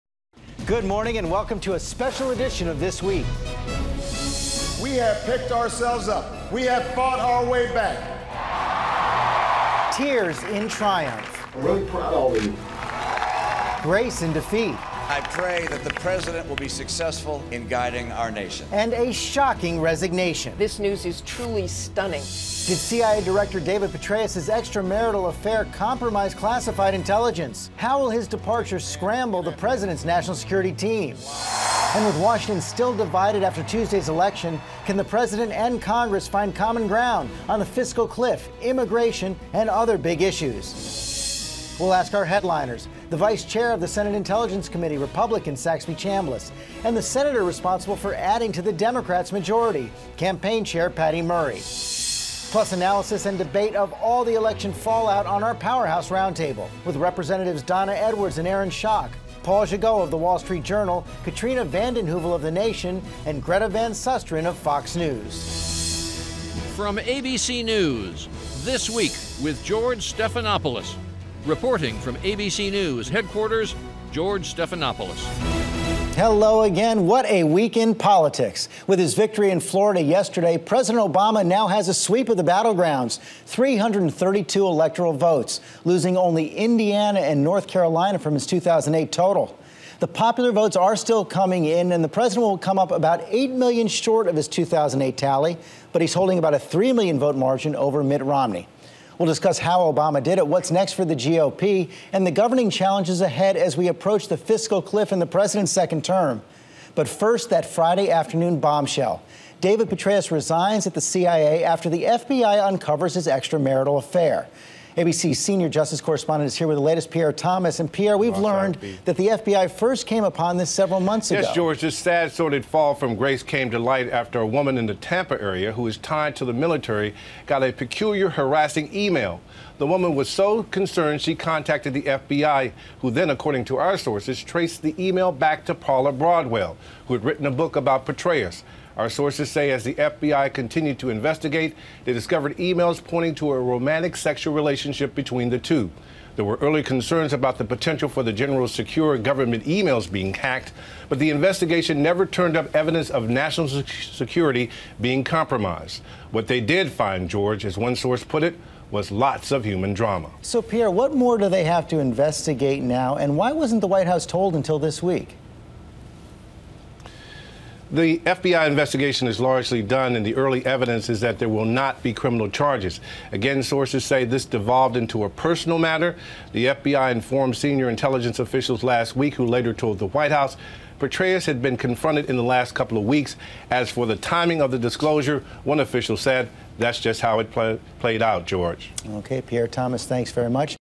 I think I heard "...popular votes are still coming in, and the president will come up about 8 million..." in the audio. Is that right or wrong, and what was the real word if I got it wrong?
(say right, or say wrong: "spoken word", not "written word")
right.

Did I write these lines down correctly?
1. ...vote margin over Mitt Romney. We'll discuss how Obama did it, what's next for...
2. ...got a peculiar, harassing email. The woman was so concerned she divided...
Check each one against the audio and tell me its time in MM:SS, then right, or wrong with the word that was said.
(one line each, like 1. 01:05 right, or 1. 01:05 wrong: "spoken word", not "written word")
1. 01:37 right
2. 02:07 wrong: "contacted", not "divided".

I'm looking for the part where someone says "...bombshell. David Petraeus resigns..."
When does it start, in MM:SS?
01:48.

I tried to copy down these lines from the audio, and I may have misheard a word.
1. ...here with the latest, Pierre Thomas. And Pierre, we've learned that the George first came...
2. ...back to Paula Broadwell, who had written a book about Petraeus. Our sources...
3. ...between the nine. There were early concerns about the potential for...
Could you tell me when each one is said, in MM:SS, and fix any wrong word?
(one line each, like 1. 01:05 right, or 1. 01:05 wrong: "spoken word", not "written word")
1. 01:56 wrong: "FBI", not "George"
2. 02:15 right
3. 02:25 wrong: "two", not "nine".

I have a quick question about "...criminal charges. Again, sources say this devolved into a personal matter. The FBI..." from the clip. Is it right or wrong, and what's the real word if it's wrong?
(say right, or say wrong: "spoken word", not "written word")
right.